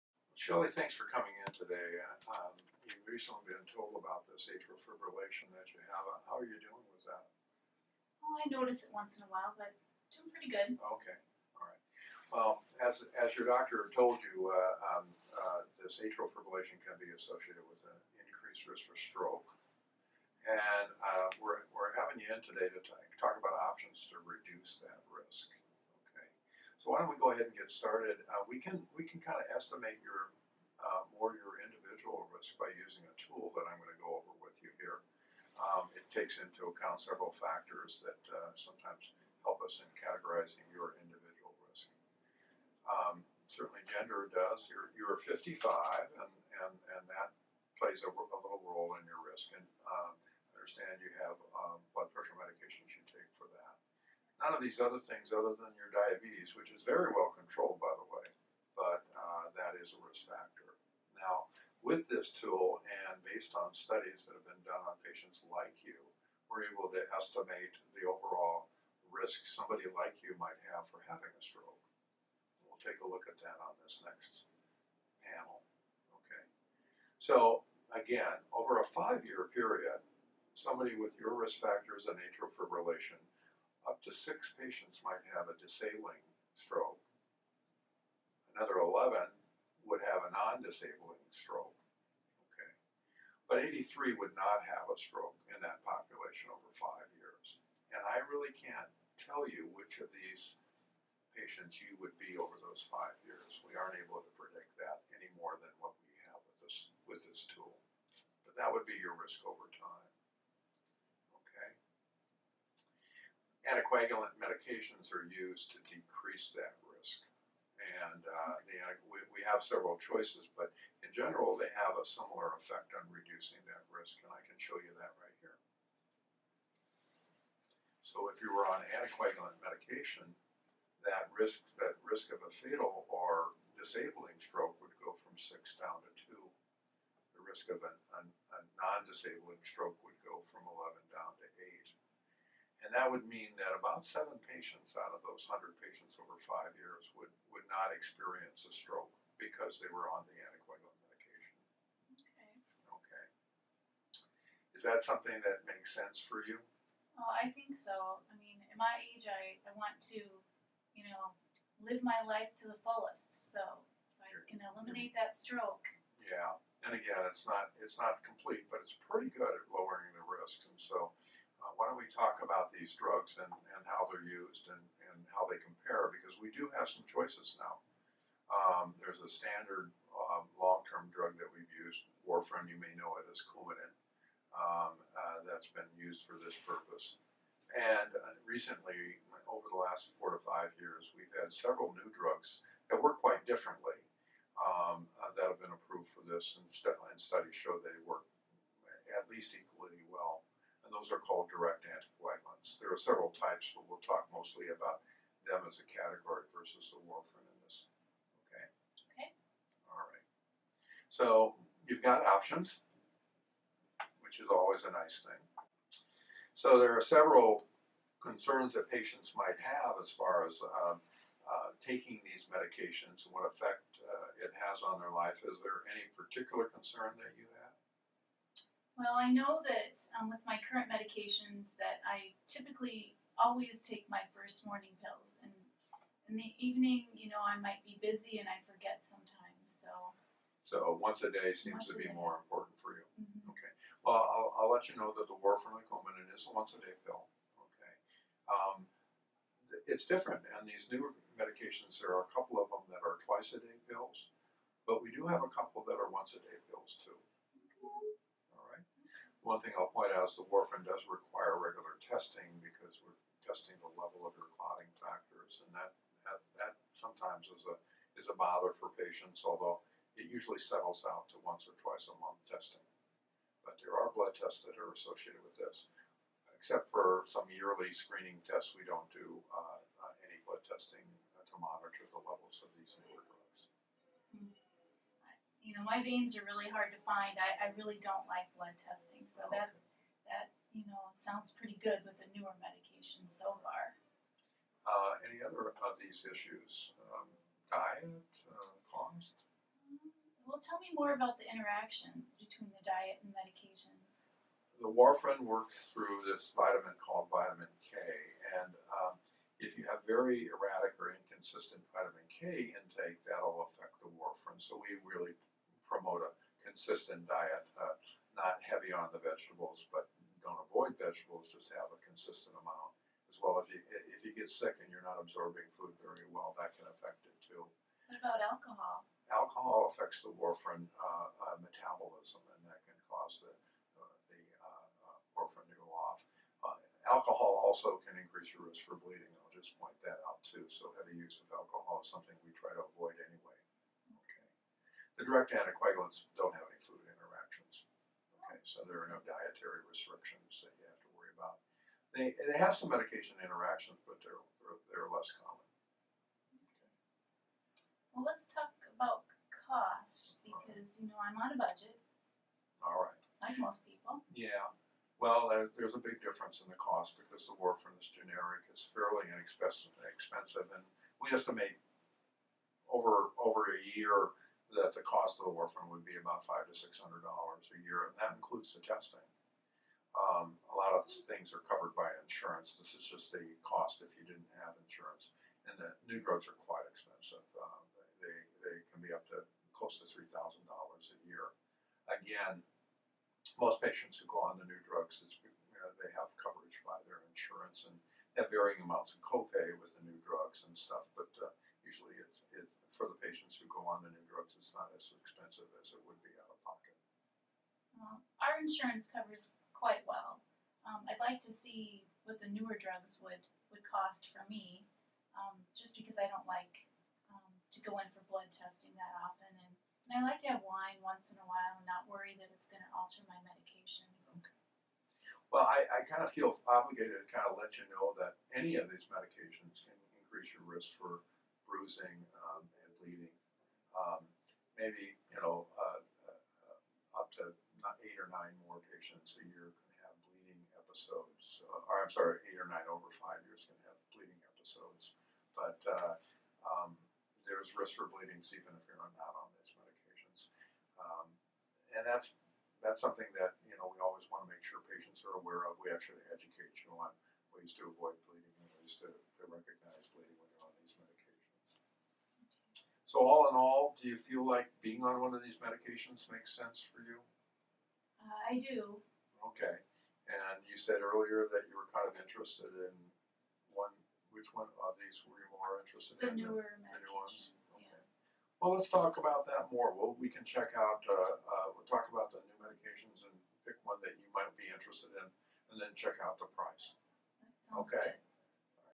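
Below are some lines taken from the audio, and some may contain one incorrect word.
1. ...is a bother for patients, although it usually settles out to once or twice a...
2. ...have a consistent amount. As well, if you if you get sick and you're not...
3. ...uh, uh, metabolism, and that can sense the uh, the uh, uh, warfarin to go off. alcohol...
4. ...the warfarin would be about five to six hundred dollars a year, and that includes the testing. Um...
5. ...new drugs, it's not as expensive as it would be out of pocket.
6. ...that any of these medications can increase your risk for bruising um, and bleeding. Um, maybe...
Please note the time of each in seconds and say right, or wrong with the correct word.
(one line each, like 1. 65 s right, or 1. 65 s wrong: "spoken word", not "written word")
1. 268 s right
2. 321 s right
3. 330 s wrong: "cause", not "sense"
4. 375 s right
5. 404 s right
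6. 428 s right.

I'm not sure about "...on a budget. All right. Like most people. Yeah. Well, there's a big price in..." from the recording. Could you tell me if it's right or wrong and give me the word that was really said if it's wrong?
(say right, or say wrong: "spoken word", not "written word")
wrong: "difference", not "price".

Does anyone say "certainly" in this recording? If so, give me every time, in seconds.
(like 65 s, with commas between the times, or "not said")
43 s.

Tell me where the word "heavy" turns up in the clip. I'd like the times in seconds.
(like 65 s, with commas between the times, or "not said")
318 s, 340 s.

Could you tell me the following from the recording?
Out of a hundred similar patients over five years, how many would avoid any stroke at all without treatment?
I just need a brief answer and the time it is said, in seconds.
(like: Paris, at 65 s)
83, at 93 s.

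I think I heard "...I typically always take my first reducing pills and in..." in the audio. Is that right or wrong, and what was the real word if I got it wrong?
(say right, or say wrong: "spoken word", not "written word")
wrong: "morning", not "reducing".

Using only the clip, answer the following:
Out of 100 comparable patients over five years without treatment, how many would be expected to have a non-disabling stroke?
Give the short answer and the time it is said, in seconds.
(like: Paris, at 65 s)
11, at 88 s.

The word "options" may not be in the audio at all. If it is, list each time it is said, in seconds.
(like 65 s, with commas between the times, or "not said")
23 s, 212 s.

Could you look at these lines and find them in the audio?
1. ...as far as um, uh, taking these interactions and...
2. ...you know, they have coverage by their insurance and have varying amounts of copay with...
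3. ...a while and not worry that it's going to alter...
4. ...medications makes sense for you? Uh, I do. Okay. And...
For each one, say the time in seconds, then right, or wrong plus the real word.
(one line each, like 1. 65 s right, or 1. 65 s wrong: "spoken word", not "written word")
1. 219 s wrong: "medications", not "interactions"
2. 395 s right
3. 421 s right
4. 465 s right.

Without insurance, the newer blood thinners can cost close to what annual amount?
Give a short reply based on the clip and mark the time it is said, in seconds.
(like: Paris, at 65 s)
$3,000, at 390 s.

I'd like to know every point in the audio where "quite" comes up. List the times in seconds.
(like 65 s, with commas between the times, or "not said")
193 s, 386 s, 409 s.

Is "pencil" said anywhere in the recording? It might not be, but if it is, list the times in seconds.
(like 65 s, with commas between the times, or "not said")
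not said.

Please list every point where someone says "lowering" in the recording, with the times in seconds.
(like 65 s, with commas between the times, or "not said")
169 s.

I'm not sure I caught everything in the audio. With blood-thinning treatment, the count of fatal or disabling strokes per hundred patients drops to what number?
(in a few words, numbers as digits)
2.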